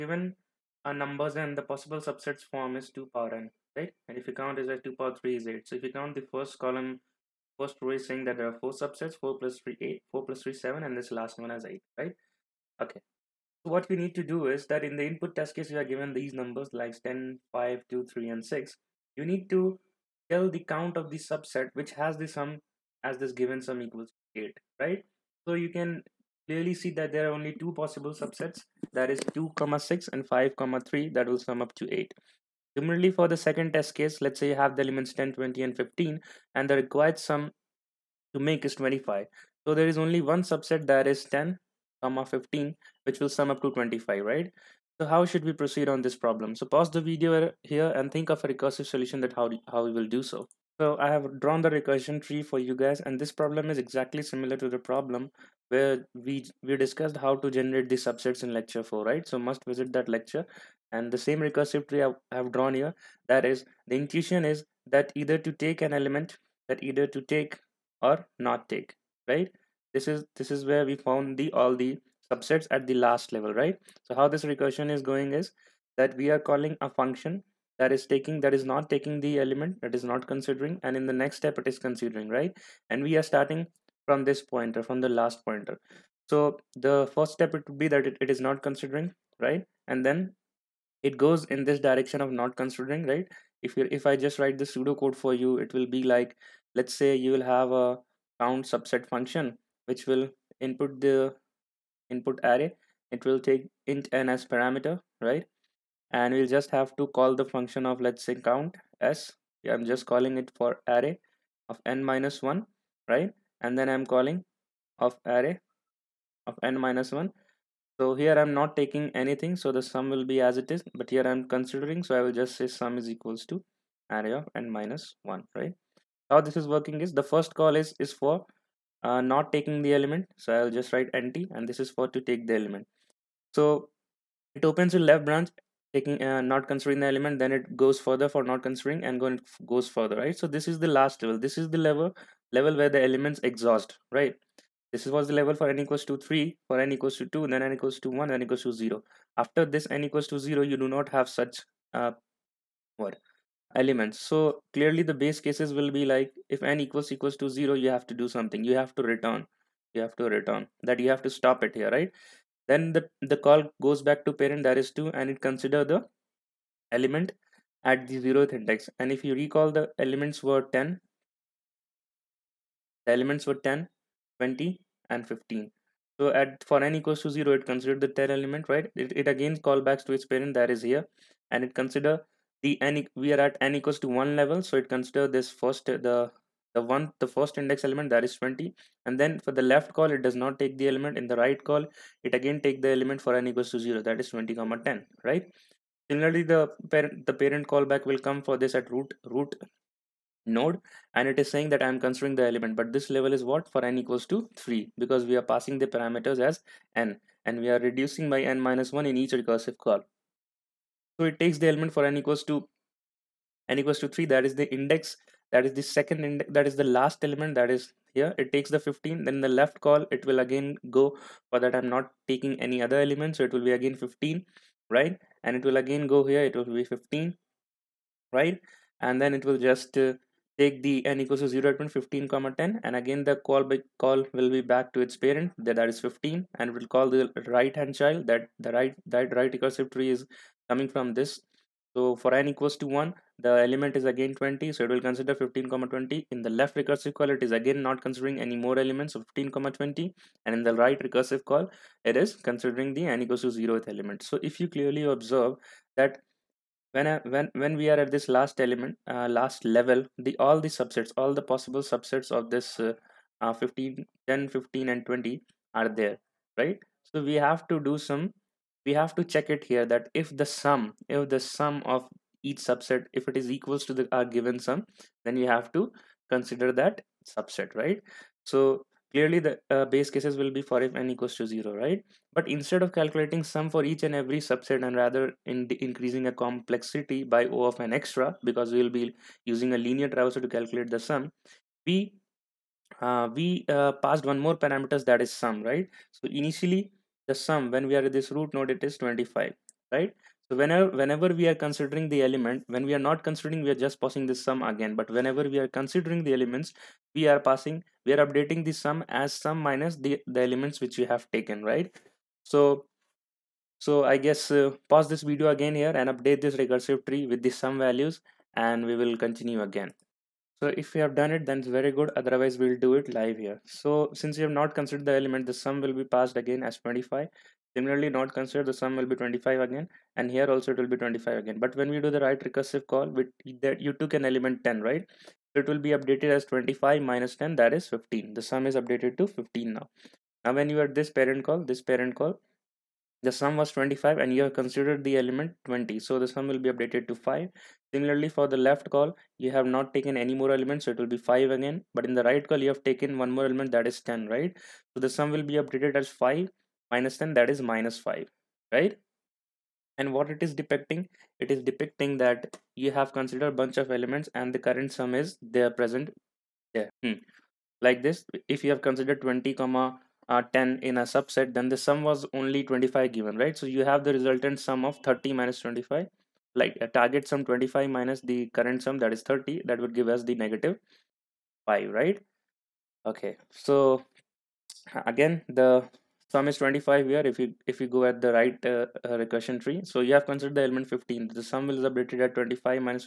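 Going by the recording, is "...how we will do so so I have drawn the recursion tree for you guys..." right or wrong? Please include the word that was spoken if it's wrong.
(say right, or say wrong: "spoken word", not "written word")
right.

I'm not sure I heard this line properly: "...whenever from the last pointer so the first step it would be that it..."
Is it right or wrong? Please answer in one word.
wrong.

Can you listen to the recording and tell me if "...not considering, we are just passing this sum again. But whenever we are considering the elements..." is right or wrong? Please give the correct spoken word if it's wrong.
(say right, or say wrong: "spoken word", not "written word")
right.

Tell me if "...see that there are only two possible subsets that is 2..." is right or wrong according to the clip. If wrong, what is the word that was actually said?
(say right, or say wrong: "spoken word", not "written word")
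right.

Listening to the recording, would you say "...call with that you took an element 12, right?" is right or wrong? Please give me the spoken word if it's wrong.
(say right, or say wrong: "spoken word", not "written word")
wrong: "10", not "12".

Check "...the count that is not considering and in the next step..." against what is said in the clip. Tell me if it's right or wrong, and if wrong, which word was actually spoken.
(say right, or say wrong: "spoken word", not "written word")
wrong: "element", not "count".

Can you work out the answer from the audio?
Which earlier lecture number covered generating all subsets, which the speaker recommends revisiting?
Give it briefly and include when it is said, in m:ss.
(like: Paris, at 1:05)
Lecture 4, at 0:58.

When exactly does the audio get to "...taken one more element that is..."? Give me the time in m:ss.
5:52.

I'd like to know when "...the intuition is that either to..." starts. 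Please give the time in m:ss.
1:03.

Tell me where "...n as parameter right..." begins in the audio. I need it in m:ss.
1:44.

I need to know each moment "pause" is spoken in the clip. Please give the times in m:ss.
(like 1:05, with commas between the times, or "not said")
0:46, 5:14.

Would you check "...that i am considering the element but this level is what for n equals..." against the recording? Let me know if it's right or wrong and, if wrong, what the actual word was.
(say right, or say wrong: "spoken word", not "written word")
right.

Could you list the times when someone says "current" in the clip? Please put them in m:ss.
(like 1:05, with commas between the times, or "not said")
6:04, 6:18.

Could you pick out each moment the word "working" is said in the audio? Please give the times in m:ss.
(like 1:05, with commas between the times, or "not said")
2:06.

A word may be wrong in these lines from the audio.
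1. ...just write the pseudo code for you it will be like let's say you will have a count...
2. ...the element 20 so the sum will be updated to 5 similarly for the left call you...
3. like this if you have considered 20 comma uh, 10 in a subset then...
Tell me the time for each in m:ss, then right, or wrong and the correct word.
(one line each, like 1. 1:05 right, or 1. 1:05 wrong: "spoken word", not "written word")
1. 1:34 right
2. 5:45 right
3. 6:07 right.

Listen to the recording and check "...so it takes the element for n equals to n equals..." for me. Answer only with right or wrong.
right.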